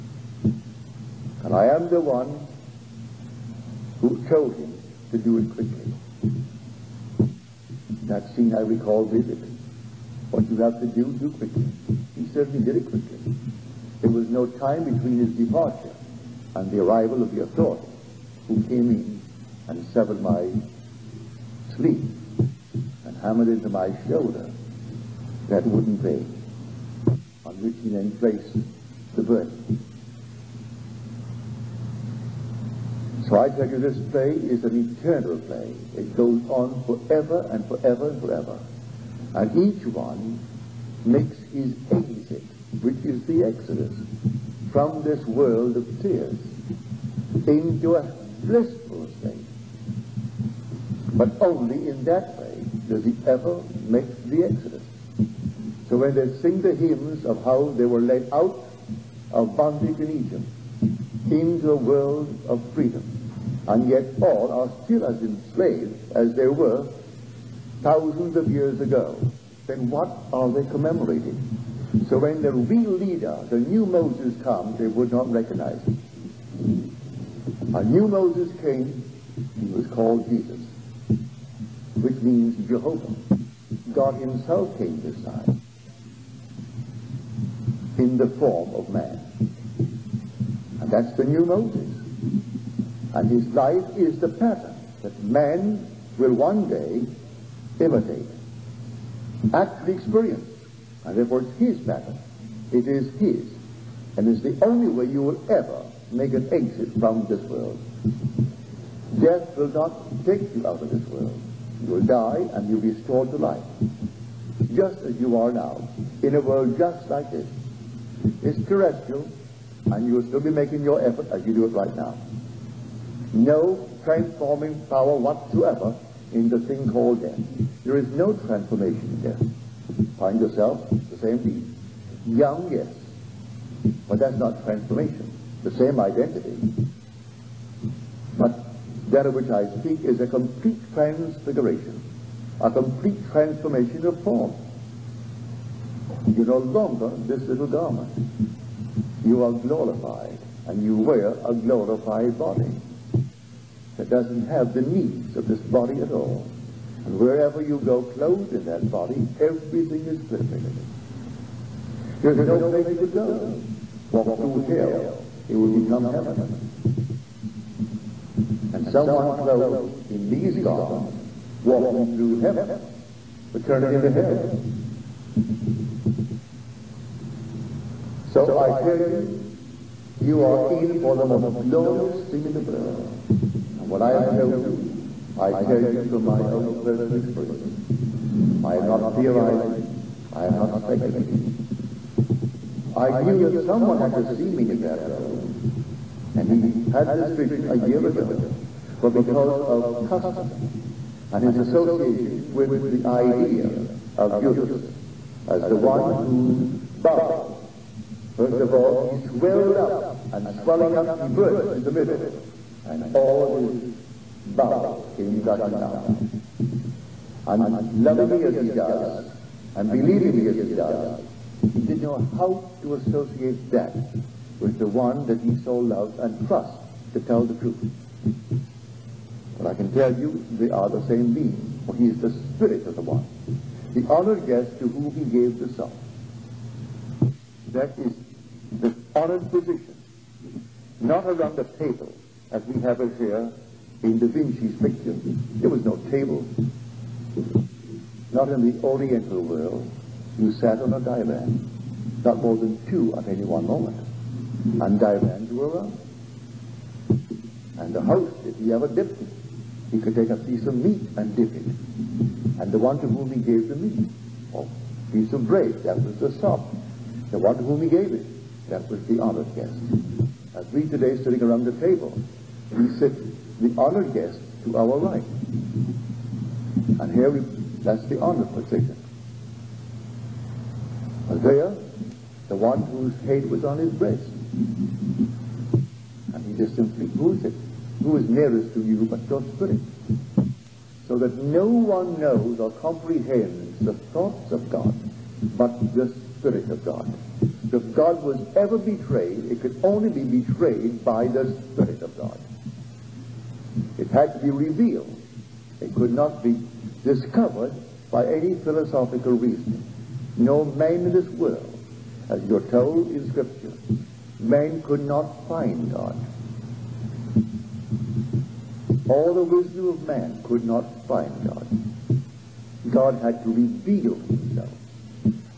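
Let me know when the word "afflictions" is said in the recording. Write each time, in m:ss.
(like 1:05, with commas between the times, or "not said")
not said.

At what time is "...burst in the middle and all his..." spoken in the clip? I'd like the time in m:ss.
3:31.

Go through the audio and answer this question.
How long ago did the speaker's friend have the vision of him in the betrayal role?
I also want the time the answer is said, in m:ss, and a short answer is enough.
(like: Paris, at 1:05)
a year ago, at 3:17.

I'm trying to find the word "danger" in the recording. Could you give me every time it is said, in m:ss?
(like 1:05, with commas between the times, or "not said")
not said.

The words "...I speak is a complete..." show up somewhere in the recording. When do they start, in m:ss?
2:19.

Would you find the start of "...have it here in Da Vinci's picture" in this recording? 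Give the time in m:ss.
4:02.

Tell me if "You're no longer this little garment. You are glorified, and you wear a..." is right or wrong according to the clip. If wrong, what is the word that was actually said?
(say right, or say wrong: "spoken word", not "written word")
right.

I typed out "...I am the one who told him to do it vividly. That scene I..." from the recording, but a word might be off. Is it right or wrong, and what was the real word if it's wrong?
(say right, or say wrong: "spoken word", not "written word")
wrong: "quickly", not "vividly".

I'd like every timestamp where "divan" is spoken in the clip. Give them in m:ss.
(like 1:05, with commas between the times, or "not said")
4:10, 4:14.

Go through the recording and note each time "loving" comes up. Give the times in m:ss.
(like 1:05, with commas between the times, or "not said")
3:37.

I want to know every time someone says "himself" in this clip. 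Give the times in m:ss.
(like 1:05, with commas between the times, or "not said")
1:24, 5:24.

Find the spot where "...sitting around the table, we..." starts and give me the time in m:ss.
4:31.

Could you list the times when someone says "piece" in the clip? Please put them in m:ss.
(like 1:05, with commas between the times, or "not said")
4:20, 4:25.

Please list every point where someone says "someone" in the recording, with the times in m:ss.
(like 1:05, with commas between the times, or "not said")
2:48, 3:13.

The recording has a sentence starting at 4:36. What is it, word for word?
And here we, that's the honored position.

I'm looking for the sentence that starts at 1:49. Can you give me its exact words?
Death will not take you out of this world.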